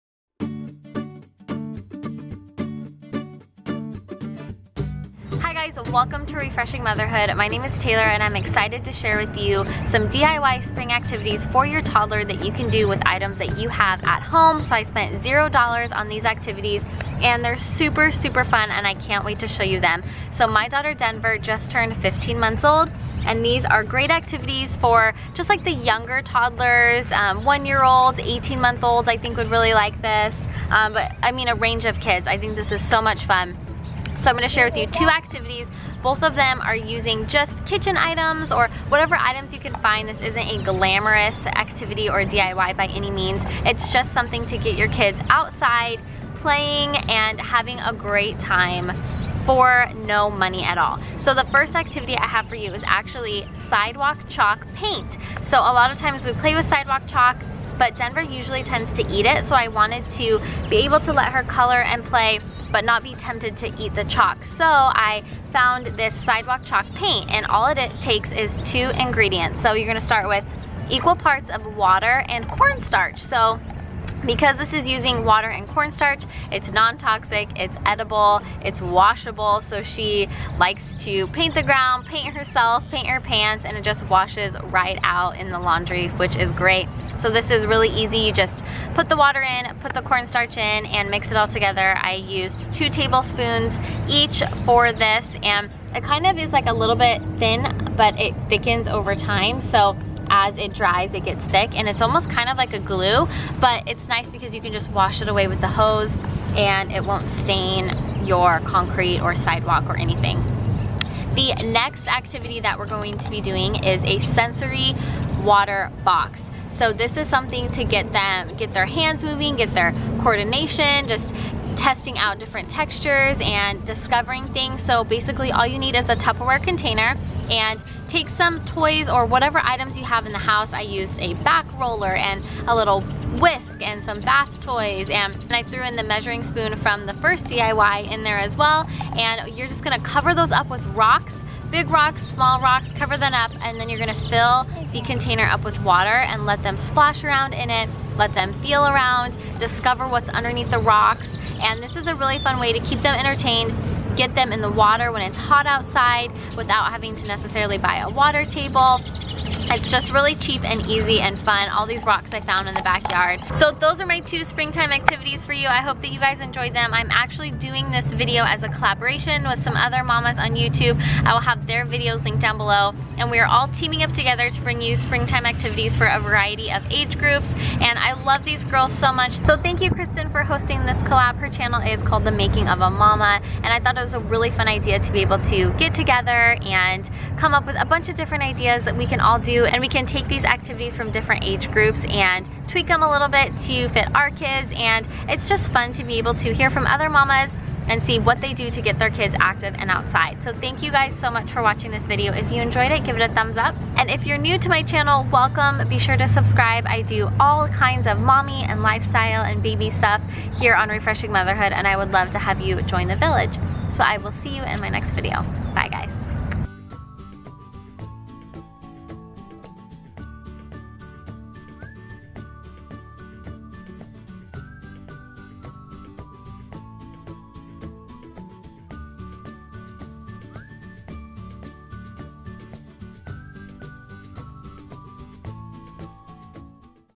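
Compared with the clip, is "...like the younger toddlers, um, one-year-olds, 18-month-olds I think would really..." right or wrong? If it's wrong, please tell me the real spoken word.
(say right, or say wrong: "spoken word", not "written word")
right.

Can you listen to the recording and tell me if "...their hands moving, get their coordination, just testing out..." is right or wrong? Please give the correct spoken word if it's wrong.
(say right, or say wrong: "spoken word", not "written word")
right.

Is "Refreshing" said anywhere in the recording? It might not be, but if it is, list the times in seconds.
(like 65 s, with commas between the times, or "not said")
6 s, 210 s.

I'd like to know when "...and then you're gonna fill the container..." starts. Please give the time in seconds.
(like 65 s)
143 s.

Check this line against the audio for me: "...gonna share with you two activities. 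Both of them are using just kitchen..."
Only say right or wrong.
right.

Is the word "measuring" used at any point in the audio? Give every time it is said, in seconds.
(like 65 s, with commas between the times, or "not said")
136 s.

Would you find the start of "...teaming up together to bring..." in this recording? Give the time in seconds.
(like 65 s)
173 s.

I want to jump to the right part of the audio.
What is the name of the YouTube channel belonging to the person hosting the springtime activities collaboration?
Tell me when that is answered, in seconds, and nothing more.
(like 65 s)
182 s.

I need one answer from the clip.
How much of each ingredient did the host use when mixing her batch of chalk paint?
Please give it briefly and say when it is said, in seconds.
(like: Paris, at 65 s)
2 tablespoons each, at 92 s.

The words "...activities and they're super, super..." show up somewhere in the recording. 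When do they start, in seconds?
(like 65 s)
16 s.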